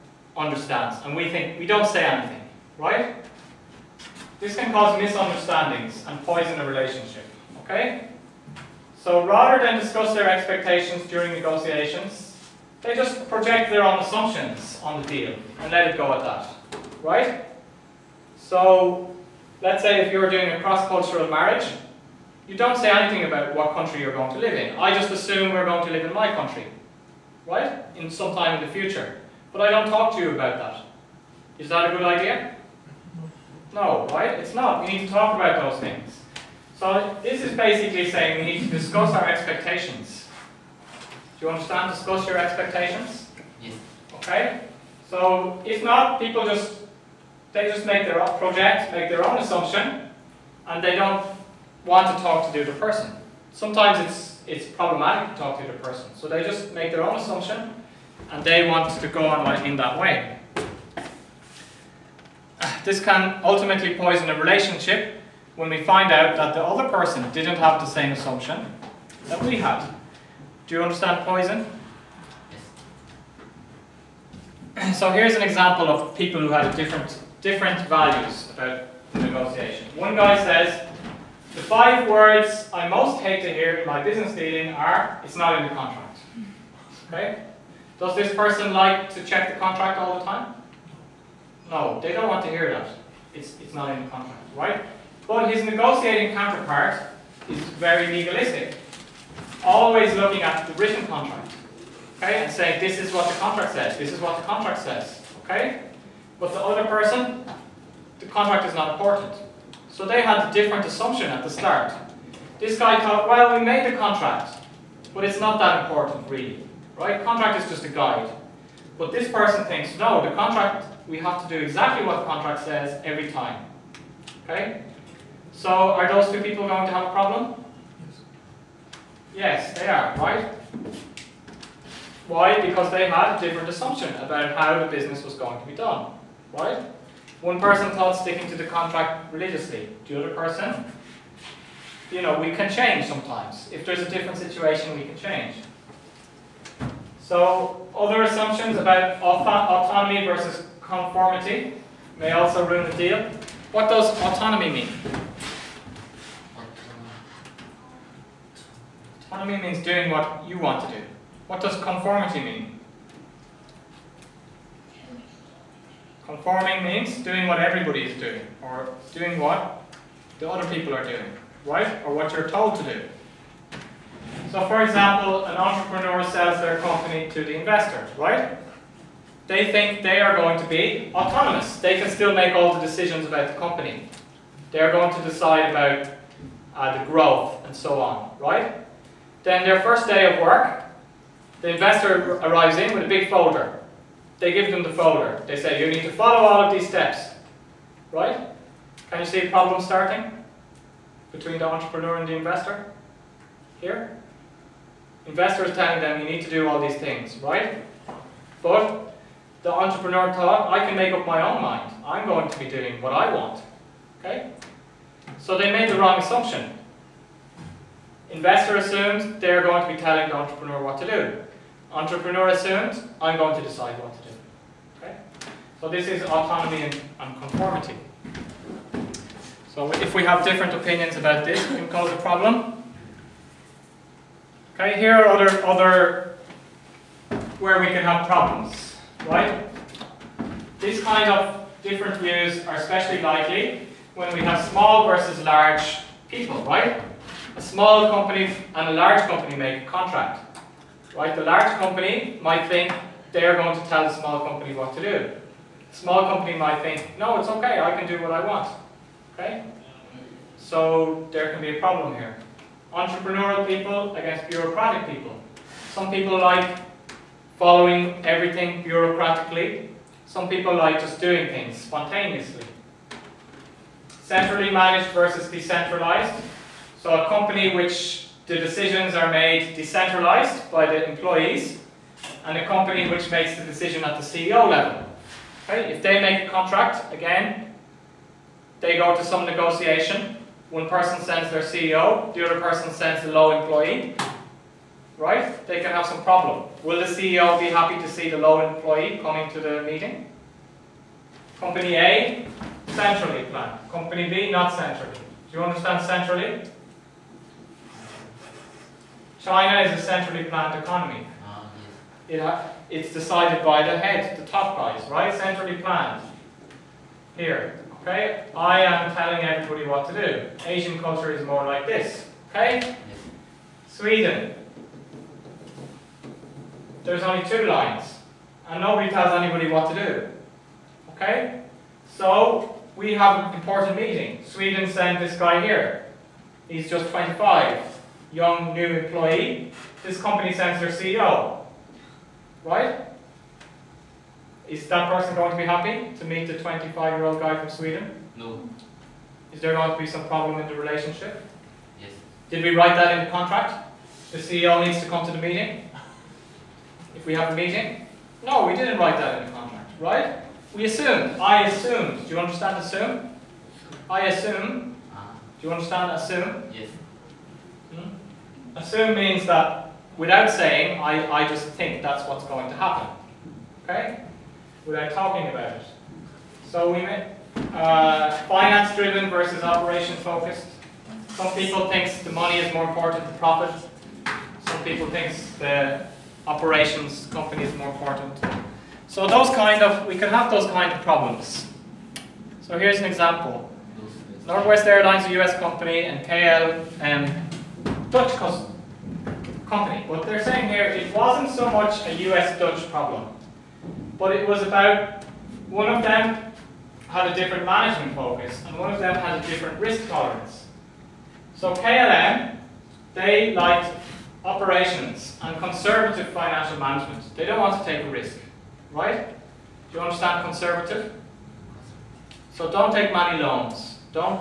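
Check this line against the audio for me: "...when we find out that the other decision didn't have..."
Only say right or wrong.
wrong.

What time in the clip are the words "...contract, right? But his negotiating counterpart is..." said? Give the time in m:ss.
1:34.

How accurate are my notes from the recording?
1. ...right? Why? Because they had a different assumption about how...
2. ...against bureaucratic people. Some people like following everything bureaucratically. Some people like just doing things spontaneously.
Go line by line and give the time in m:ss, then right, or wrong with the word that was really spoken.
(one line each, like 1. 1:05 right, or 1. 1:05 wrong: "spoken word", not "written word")
1. 2:10 right
2. 4:24 right.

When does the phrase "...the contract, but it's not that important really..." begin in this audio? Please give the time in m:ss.
1:53.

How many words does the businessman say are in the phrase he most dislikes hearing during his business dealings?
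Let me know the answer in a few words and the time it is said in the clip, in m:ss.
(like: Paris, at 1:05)
5, at 1:21.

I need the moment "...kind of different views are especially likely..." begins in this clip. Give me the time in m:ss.
4:01.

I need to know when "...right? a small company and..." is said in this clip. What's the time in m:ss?
4:06.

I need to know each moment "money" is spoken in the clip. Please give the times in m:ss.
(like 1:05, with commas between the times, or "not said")
6:22, 7:03.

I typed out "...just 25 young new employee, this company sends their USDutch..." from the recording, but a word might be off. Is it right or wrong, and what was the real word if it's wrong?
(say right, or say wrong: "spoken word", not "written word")
wrong: "CEO", not "USDutch".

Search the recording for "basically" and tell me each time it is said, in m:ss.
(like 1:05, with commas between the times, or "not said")
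0:37.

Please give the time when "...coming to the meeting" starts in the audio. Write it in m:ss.
4:59.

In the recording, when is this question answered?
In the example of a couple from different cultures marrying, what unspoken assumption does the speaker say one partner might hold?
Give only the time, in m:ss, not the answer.
0:25.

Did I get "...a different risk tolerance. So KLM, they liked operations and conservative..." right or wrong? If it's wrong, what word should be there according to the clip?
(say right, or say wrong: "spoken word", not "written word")
right.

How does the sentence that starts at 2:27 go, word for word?
So other assumptions about autonomy versus conformity may also ruin the deal.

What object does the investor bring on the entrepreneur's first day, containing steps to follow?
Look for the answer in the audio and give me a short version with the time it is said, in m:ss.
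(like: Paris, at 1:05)
big folder, at 3:13.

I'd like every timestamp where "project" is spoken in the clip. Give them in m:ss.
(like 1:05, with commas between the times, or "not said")
0:13, 0:48.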